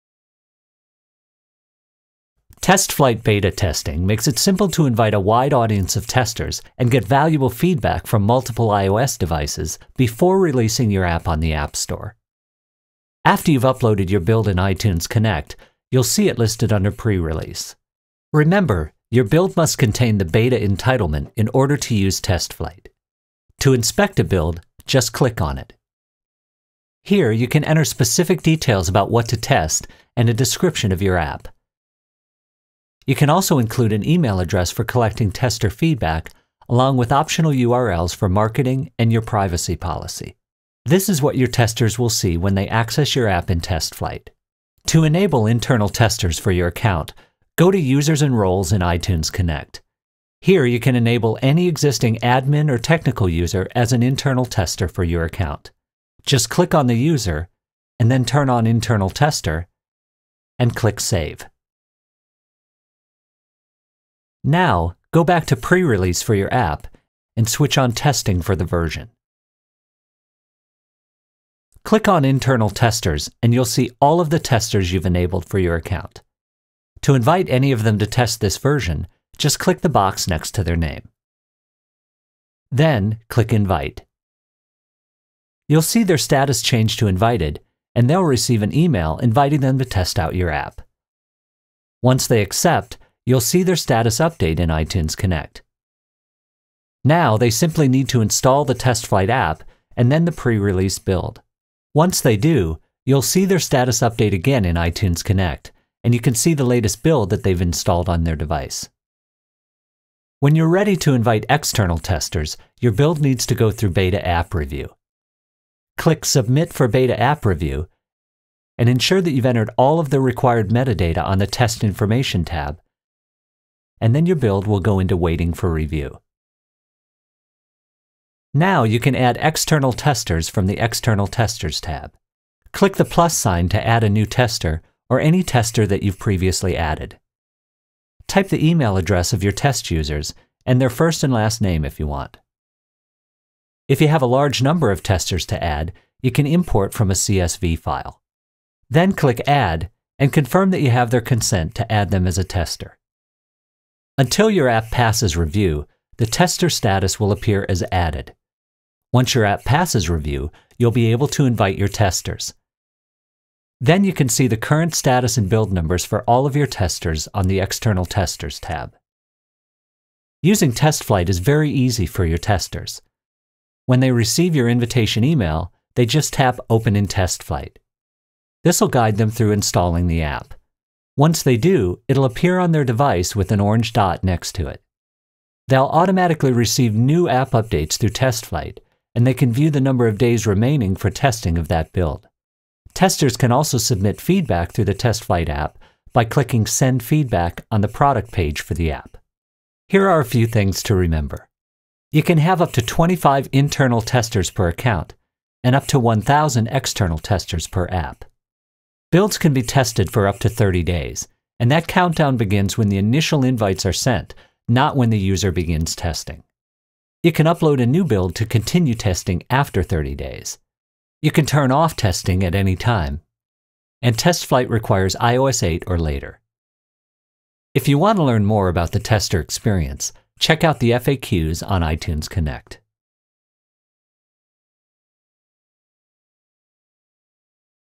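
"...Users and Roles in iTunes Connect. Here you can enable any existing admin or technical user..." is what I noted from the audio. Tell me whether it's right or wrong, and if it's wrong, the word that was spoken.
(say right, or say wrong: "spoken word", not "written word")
right.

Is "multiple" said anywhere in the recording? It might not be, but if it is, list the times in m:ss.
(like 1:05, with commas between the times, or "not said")
0:08.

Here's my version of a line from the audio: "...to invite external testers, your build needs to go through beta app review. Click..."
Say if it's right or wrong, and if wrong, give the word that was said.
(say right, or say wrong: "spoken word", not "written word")
right.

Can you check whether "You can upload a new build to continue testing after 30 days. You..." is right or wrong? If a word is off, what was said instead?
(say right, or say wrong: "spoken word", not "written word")
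right.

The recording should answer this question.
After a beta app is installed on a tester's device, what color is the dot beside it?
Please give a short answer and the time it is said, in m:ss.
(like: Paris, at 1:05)
Orange, at 3:03.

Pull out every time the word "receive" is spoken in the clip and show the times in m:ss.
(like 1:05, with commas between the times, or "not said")
1:28, 2:54, 3:06.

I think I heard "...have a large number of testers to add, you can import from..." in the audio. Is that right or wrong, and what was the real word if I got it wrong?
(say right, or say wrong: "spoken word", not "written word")
right.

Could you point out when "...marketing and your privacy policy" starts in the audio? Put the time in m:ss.
0:38.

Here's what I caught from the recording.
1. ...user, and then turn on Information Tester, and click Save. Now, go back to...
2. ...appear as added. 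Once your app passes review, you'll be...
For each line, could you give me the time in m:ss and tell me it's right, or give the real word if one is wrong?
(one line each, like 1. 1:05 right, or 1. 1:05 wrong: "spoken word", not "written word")
1. 0:56 wrong: "Internal", not "Information"
2. 2:37 right.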